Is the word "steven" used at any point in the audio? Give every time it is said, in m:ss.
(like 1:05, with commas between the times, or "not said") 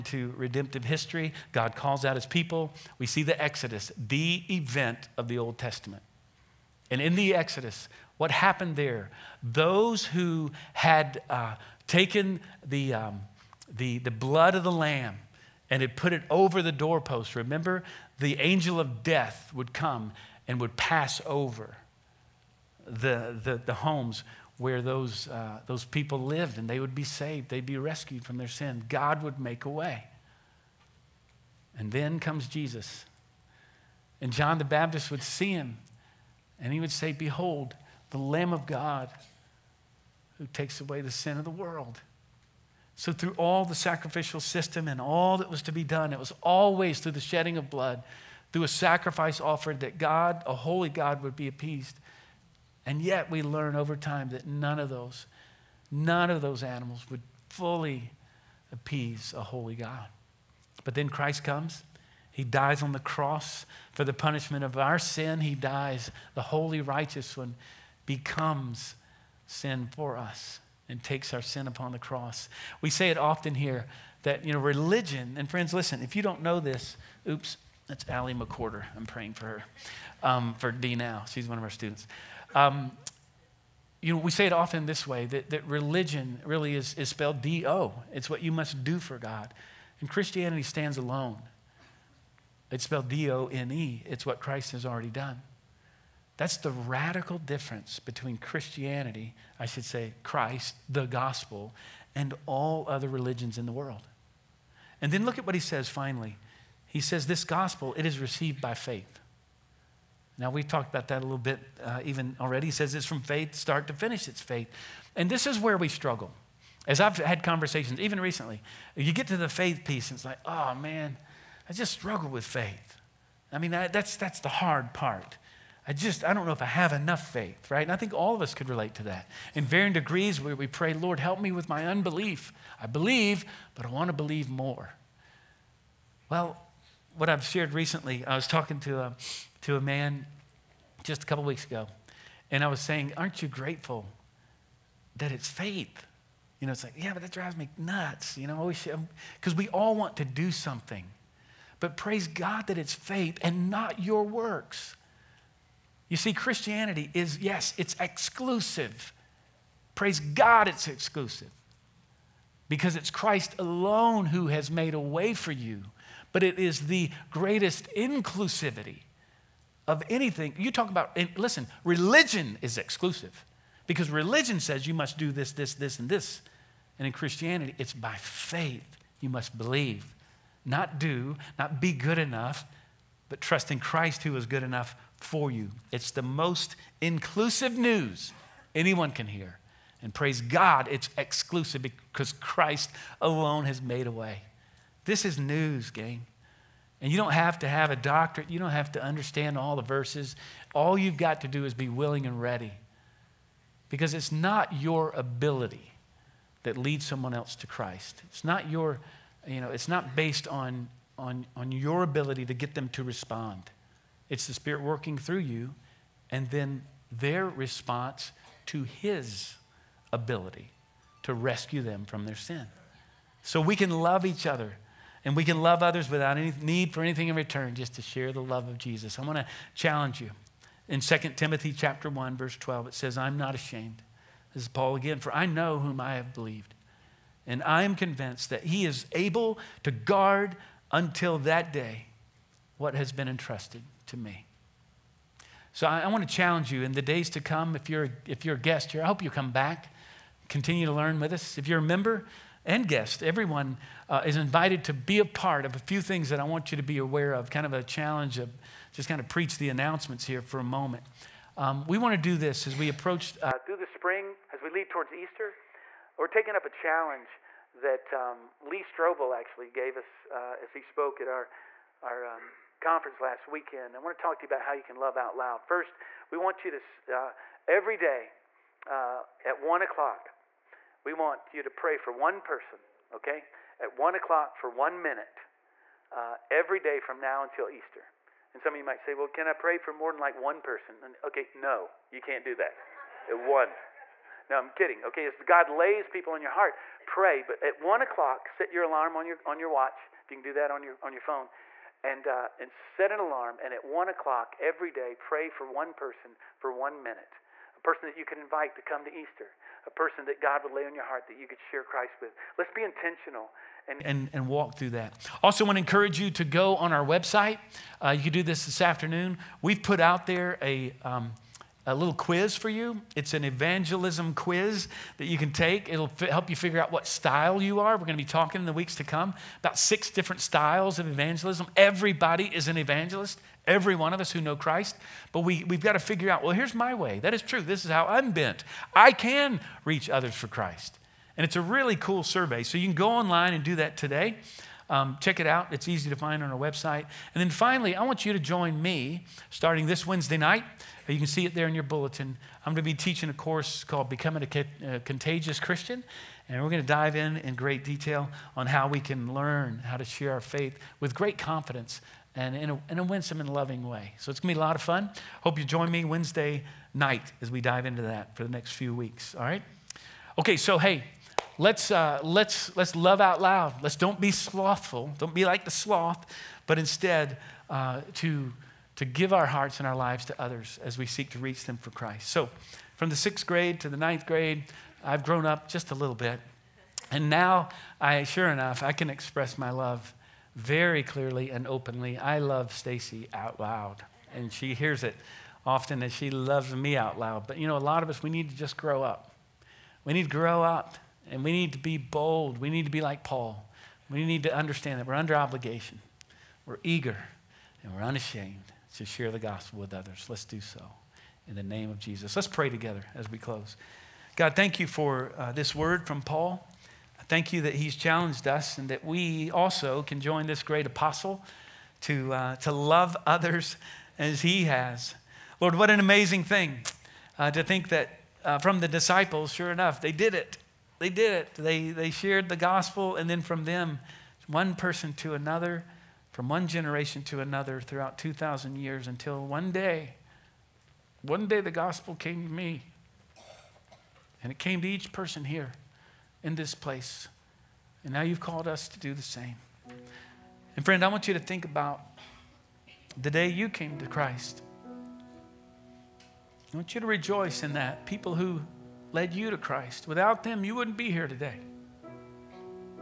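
not said.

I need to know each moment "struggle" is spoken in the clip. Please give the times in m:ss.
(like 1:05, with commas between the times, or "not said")
1:55, 2:01.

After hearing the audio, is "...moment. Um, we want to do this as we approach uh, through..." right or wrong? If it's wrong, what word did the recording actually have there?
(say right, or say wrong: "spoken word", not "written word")
right.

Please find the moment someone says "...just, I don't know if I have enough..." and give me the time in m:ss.
2:05.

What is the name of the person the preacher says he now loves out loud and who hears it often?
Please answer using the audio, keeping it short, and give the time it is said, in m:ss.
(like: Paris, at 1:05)
Stacy, at 6:32.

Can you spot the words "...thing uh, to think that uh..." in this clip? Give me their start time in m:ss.
7:06.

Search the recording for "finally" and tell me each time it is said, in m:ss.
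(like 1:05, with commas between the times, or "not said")
1:45, 5:47.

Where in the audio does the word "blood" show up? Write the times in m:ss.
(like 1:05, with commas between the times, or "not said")
0:14, 0:47.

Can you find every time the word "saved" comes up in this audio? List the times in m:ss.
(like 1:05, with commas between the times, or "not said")
0:27.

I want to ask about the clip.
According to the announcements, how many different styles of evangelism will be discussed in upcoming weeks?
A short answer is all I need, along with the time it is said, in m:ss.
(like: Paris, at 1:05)
6, at 5:29.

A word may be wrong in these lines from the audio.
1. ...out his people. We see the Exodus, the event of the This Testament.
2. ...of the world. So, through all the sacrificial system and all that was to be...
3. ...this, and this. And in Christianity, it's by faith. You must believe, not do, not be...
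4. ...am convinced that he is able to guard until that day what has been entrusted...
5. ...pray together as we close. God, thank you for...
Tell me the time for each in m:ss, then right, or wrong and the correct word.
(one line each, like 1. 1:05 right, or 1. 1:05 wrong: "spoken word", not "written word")
1. 0:02 wrong: "Old", not "This"
2. 0:41 right
3. 2:55 right
4. 3:57 right
5. 6:52 right.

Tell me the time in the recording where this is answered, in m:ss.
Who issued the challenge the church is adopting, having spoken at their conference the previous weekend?
4:28.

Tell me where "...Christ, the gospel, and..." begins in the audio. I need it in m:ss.
1:40.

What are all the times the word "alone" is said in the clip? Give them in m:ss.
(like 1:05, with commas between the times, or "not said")
1:30, 2:43, 3:13.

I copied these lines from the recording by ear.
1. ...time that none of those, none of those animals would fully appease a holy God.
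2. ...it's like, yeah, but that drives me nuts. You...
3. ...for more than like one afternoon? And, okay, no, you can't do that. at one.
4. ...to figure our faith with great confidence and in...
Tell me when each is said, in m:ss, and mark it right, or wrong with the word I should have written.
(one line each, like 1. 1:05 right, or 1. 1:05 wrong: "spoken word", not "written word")
1. 0:53 right
2. 2:26 right
3. 4:49 wrong: "person", not "afternoon"
4. 5:59 wrong: "share", not "figure".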